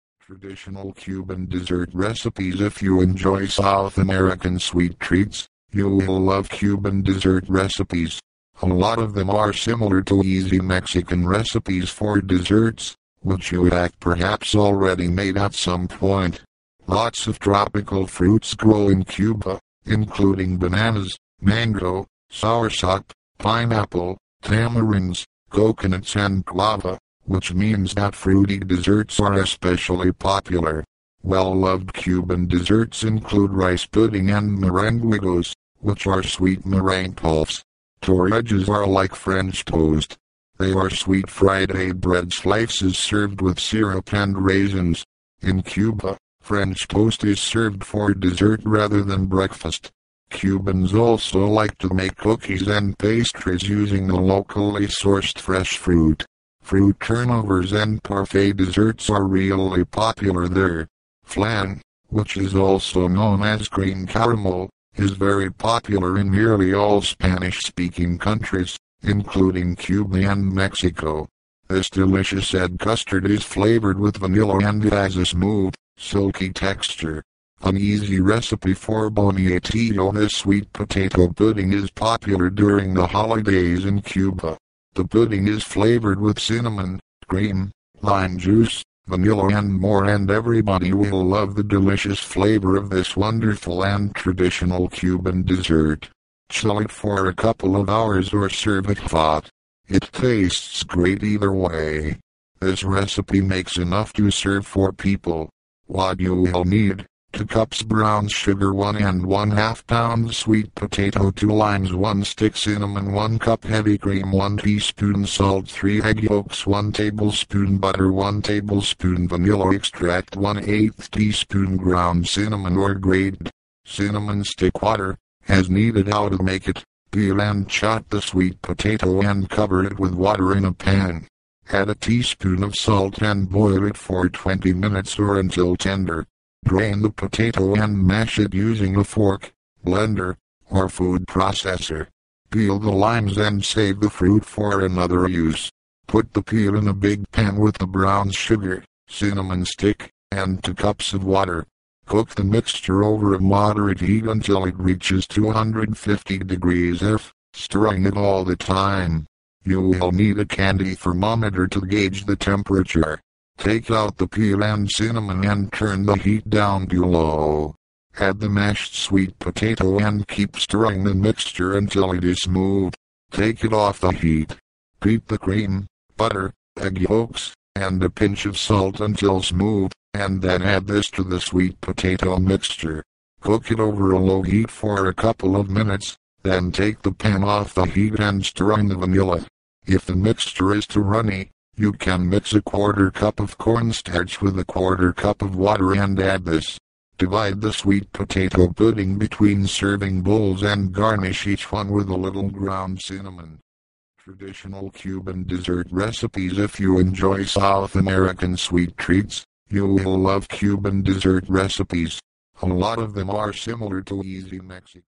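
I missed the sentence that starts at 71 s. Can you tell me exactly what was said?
This delicious egg custard is flavored with vanilla and has a smooth, silky texture.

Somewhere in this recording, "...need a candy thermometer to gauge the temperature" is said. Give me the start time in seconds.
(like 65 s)
160 s.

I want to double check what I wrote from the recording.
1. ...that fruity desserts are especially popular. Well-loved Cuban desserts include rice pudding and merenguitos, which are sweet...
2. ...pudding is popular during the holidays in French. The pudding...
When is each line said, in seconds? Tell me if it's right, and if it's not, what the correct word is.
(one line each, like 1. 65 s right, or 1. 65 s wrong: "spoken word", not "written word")
1. 27 s right
2. 81 s wrong: "Cuba", not "French".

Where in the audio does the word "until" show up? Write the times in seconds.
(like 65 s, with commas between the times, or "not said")
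135 s, 154 s, 171 s, 178 s.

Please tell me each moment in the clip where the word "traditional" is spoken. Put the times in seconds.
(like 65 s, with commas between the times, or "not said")
0 s, 94 s, 204 s.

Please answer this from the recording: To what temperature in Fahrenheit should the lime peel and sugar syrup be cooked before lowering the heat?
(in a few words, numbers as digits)
250 degrees F.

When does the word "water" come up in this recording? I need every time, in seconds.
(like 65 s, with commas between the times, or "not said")
124 s, 130 s, 151 s, 195 s.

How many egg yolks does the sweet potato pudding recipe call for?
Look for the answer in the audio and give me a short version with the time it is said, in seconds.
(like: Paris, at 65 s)
3, at 115 s.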